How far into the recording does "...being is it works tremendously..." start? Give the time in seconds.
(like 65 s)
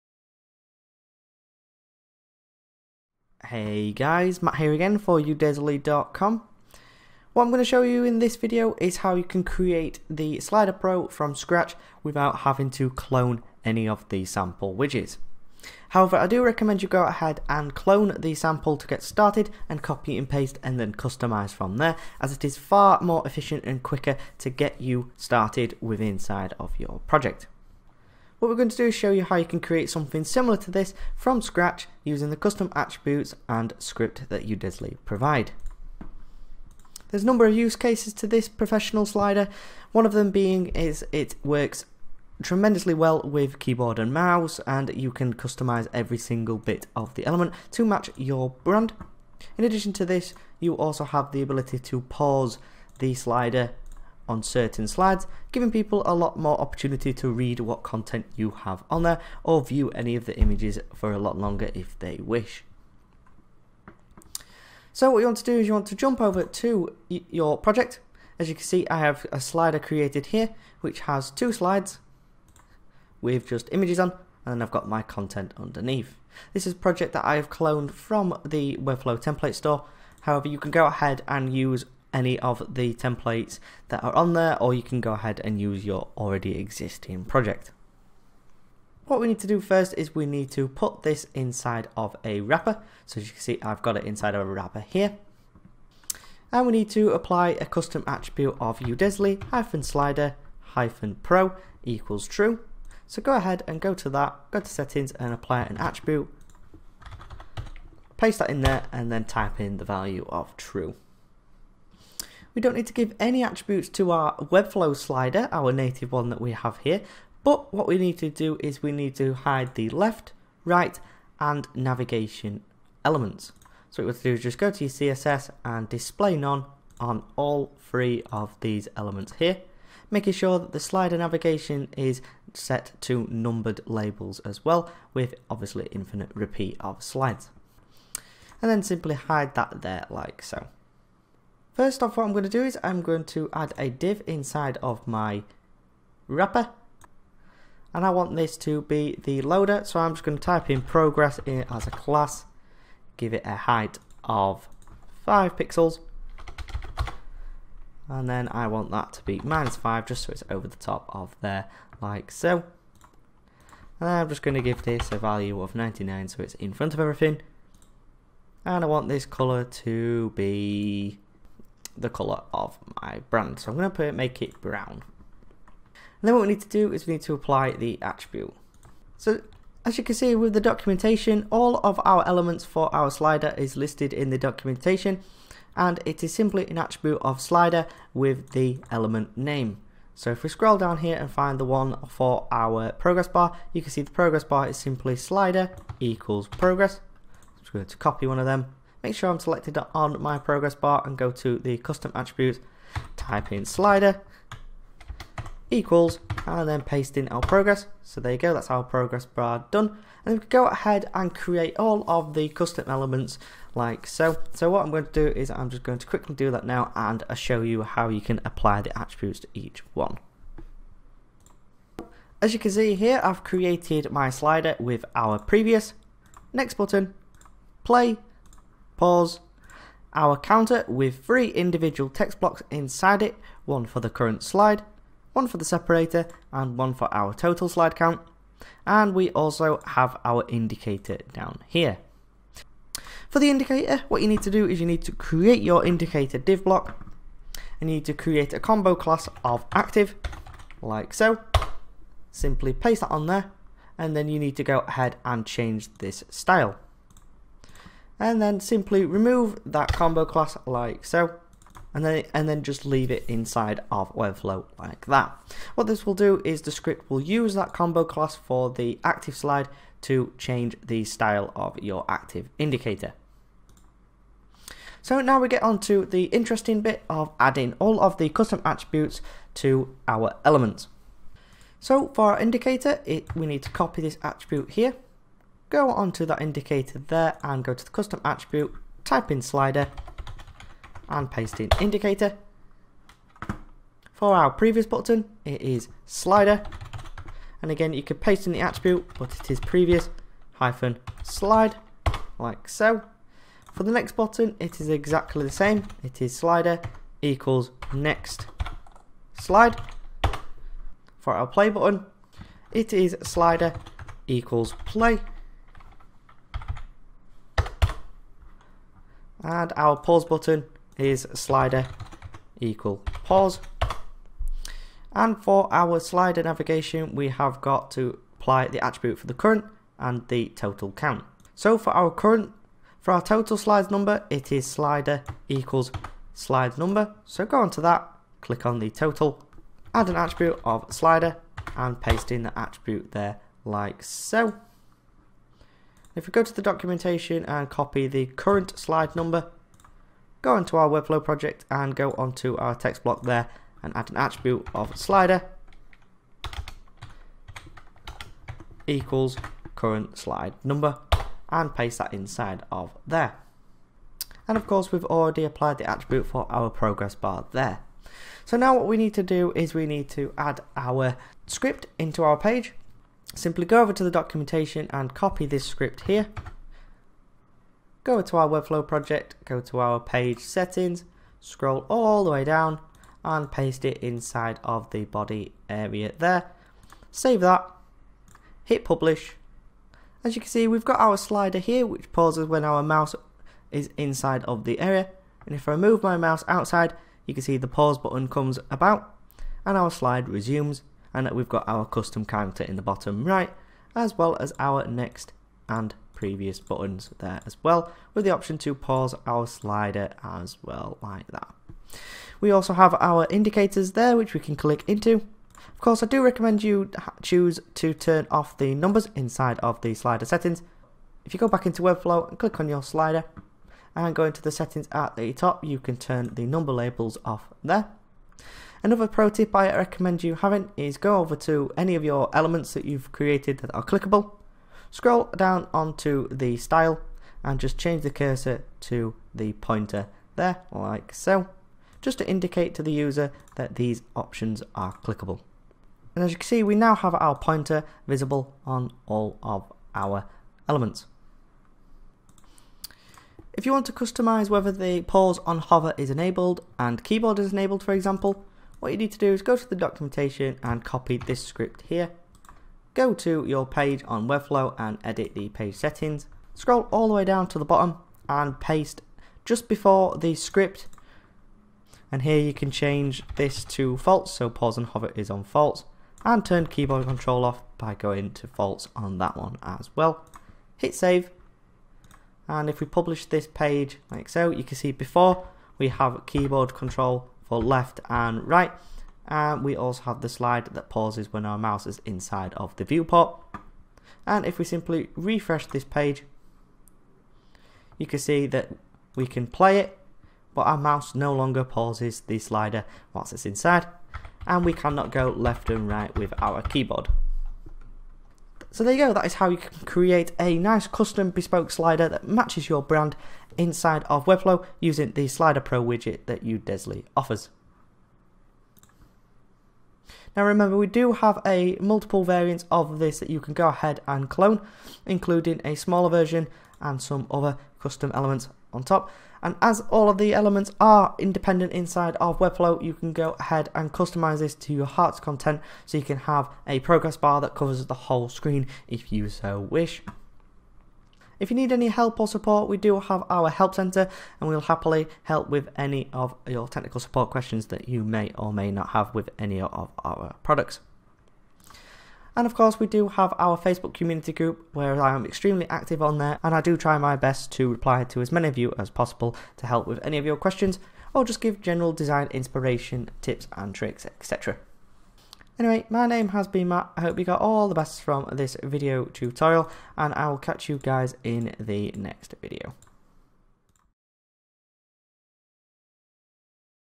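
40 s.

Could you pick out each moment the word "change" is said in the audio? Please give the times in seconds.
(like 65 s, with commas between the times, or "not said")
255 s, 270 s, 437 s, 472 s.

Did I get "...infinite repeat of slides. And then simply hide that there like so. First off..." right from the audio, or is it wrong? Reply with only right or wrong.
right.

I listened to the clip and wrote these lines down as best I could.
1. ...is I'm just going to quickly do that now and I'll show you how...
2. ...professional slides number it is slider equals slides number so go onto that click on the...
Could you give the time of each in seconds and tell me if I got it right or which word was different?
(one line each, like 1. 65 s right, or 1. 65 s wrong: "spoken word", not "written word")
1. 215 s right
2. 333 s wrong: "total", not "professional".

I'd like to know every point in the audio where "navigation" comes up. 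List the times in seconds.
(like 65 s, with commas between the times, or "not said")
121 s, 131 s, 326 s.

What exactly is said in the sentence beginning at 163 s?
And I'm just going to give this a value of 99, so it's in front of everything.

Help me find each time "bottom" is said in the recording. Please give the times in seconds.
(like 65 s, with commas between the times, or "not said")
402 s, 467 s.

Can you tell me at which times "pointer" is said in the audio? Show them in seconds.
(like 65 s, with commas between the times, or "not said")
439 s, 447 s.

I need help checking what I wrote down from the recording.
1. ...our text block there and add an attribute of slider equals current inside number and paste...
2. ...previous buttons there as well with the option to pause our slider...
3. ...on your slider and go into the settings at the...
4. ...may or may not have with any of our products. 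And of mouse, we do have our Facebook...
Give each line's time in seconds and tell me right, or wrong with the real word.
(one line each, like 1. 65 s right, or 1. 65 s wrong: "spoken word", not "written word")
1. 352 s wrong: "slide", not "inside"
2. 406 s right
3. 422 s right
4. 548 s wrong: "course", not "mouse".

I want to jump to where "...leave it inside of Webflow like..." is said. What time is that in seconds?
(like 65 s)
262 s.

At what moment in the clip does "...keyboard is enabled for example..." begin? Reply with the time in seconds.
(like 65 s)
457 s.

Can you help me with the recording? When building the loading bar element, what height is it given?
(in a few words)
5 pixels.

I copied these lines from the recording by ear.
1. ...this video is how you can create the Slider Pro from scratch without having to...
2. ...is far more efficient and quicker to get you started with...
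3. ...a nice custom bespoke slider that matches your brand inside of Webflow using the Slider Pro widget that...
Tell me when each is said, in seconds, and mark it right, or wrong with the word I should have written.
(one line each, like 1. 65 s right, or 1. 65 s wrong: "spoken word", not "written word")
1. 8 s right
2. 22 s right
3. 510 s right.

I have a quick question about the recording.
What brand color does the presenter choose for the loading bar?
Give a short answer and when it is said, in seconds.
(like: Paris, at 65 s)
brown, at 174 s.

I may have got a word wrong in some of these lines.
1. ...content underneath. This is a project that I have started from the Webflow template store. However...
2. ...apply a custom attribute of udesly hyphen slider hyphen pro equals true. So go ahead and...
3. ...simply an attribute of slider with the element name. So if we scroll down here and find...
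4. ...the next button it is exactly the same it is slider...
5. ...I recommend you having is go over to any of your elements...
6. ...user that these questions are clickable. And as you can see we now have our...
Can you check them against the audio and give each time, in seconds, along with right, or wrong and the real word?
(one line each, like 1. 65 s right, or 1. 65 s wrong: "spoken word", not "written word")
1. 75 s wrong: "cloned", not "started"
2. 97 s right
3. 186 s right
4. 303 s right
5. 429 s right
6. 442 s wrong: "options", not "questions".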